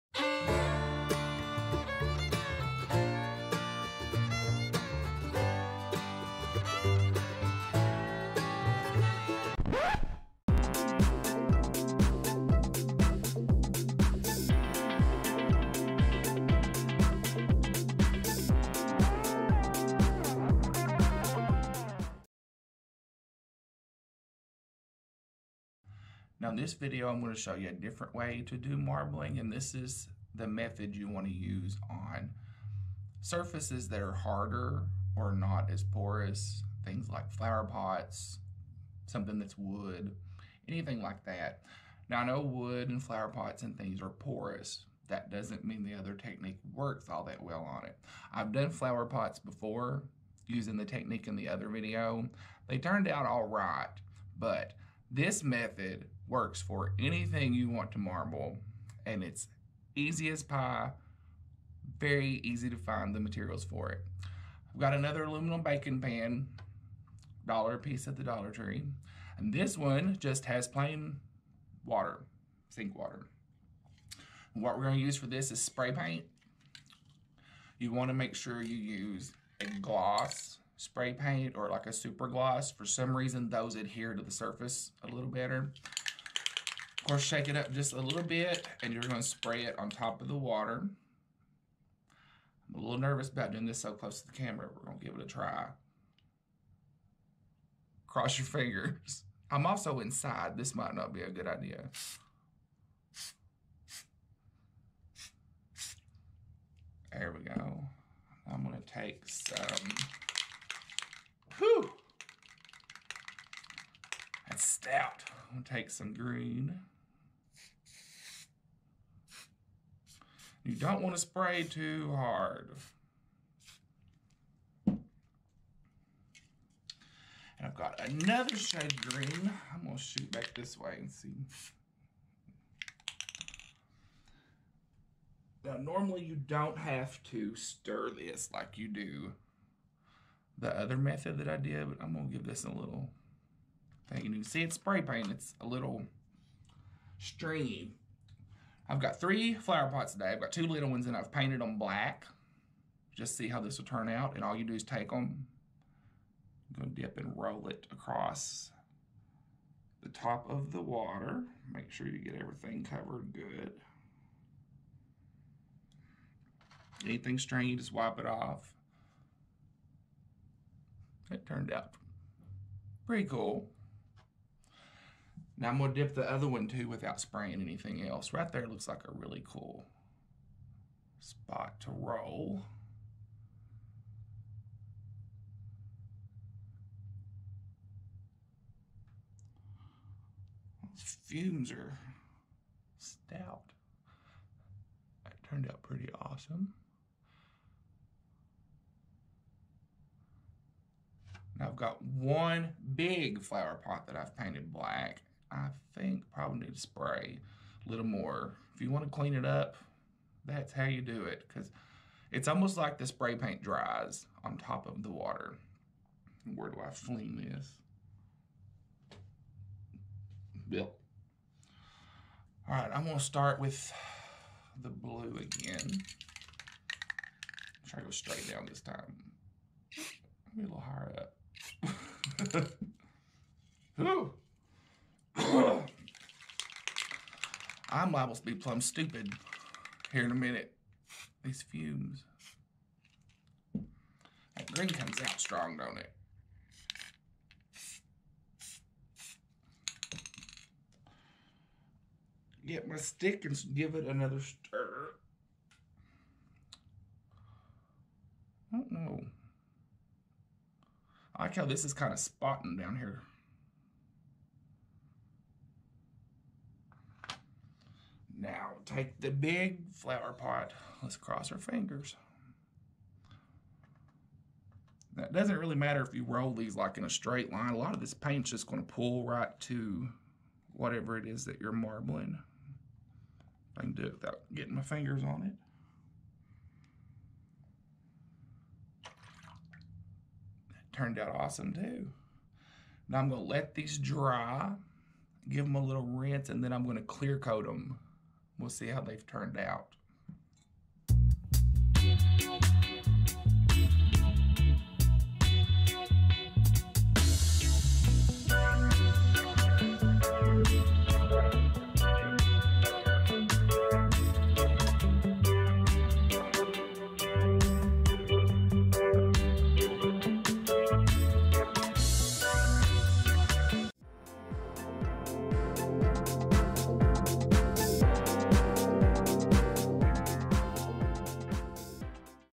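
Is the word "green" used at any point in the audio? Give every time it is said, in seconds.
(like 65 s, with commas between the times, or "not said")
116 s, 129 s, 244 s.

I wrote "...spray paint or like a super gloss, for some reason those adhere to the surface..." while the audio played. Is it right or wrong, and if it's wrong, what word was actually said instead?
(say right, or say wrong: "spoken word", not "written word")
right.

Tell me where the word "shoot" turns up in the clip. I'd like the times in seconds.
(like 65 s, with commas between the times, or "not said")
129 s.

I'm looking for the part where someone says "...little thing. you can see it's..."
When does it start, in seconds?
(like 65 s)
142 s.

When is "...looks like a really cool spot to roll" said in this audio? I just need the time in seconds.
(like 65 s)
178 s.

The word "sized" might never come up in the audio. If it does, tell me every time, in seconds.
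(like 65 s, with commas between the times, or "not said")
not said.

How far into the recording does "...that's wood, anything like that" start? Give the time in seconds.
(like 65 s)
39 s.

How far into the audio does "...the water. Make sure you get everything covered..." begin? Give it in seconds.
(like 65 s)
160 s.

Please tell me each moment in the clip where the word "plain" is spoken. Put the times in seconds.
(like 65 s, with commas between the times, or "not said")
70 s.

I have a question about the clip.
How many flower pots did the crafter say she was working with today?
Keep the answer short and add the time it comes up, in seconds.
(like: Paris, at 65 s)
3, at 149 s.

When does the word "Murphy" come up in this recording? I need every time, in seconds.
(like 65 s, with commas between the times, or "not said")
not said.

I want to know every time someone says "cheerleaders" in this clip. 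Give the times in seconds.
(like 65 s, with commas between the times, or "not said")
not said.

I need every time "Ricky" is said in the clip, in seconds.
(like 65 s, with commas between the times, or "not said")
not said.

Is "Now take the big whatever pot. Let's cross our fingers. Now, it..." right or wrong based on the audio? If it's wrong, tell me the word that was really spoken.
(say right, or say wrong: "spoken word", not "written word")
wrong: "flower", not "whatever".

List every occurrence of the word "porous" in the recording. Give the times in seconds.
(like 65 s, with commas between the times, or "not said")
35 s, 44 s.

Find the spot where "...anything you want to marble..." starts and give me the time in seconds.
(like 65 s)
56 s.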